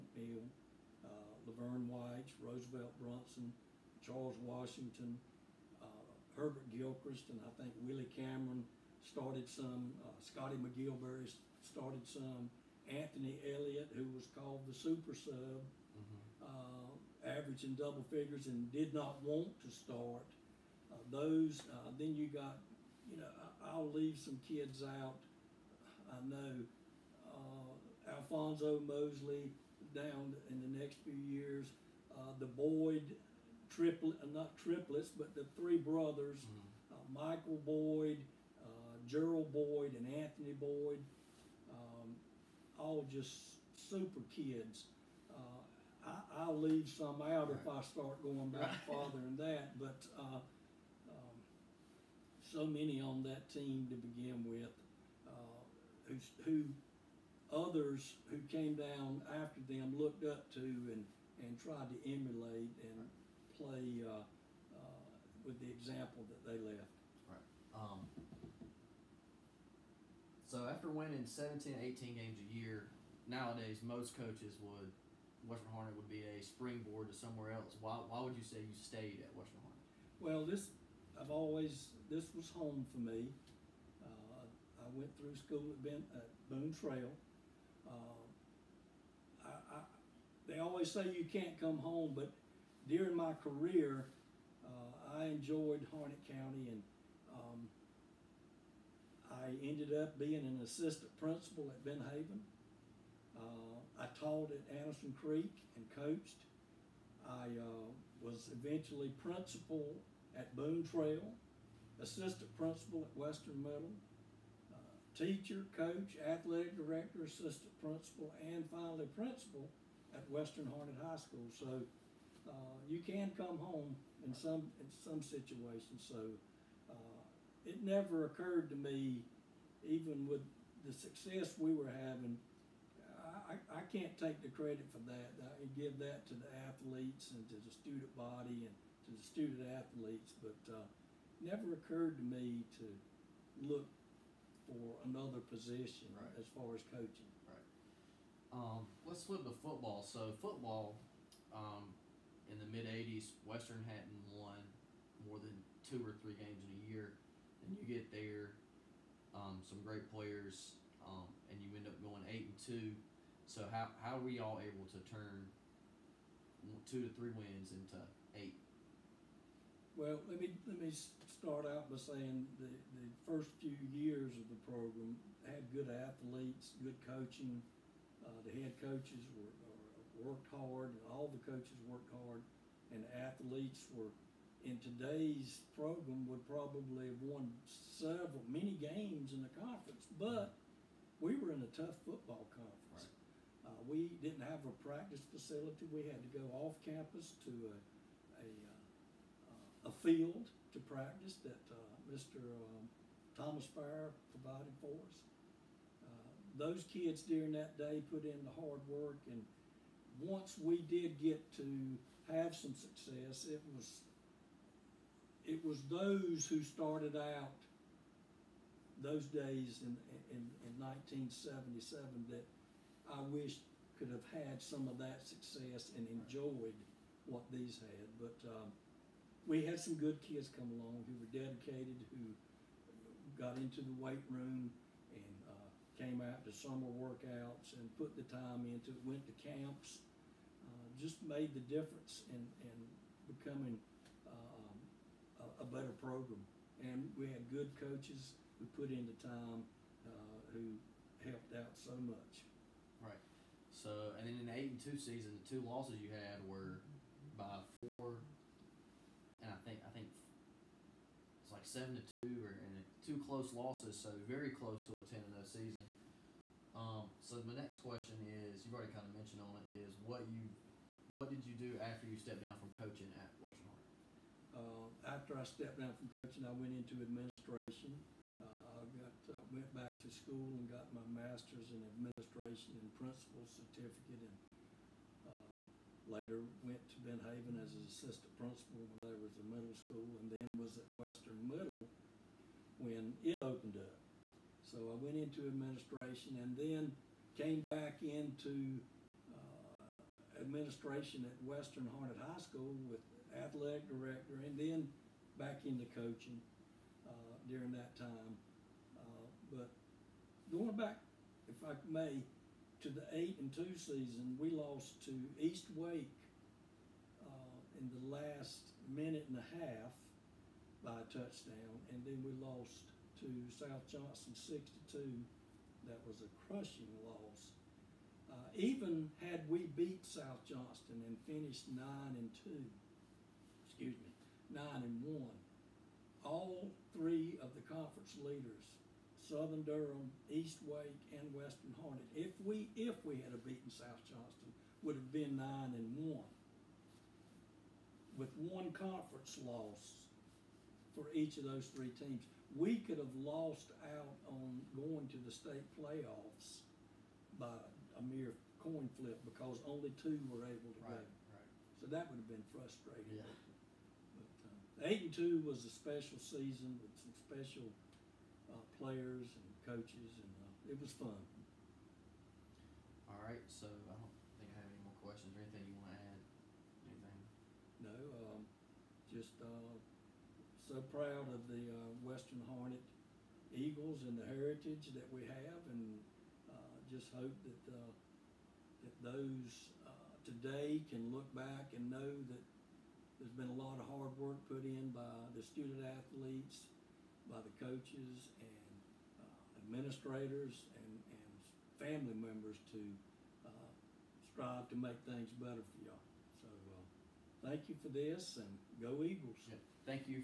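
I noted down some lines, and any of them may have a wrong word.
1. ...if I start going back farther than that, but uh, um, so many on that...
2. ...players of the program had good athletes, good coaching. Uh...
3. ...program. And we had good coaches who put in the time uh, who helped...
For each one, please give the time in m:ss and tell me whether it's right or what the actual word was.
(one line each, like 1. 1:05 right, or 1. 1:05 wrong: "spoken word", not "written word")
1. 0:47 right
2. 2:53 wrong: "years", not "players"
3. 4:06 right.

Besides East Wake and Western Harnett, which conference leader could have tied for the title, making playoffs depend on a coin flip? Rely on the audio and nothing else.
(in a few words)
Southern Durham.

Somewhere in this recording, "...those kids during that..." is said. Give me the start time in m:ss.
3:26.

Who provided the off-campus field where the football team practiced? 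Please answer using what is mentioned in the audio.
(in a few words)
Thomas Fire.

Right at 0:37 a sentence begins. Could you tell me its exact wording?
Michael Boyd, Gerald Boyd, and Anthony Boyd all just super kids.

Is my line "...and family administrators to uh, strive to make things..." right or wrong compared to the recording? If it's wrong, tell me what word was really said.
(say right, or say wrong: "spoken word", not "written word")
wrong: "members", not "administrators".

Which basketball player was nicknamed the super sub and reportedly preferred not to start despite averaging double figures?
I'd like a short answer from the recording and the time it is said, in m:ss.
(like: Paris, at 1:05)
Anthony Elliott, at 0:12.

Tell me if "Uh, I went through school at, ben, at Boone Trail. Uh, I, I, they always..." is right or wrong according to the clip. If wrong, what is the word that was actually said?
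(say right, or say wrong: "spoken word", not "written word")
right.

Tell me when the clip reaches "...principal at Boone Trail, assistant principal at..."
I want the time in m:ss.
1:49.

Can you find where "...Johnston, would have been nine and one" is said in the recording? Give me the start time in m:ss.
5:44.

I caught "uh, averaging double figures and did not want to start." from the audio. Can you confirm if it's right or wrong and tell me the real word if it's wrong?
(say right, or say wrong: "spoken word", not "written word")
right.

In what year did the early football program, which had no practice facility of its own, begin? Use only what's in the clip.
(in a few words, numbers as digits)
1977.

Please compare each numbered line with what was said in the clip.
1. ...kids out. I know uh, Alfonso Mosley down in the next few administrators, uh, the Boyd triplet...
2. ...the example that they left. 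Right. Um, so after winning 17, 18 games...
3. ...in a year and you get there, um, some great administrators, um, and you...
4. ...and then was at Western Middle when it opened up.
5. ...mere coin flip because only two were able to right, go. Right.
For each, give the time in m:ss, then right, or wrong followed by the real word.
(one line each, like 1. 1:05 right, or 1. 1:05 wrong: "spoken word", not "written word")
1. 0:24 wrong: "years", not "administrators"
2. 1:05 right
3. 2:36 wrong: "players", not "administrators"
4. 4:50 right
5. 5:58 right.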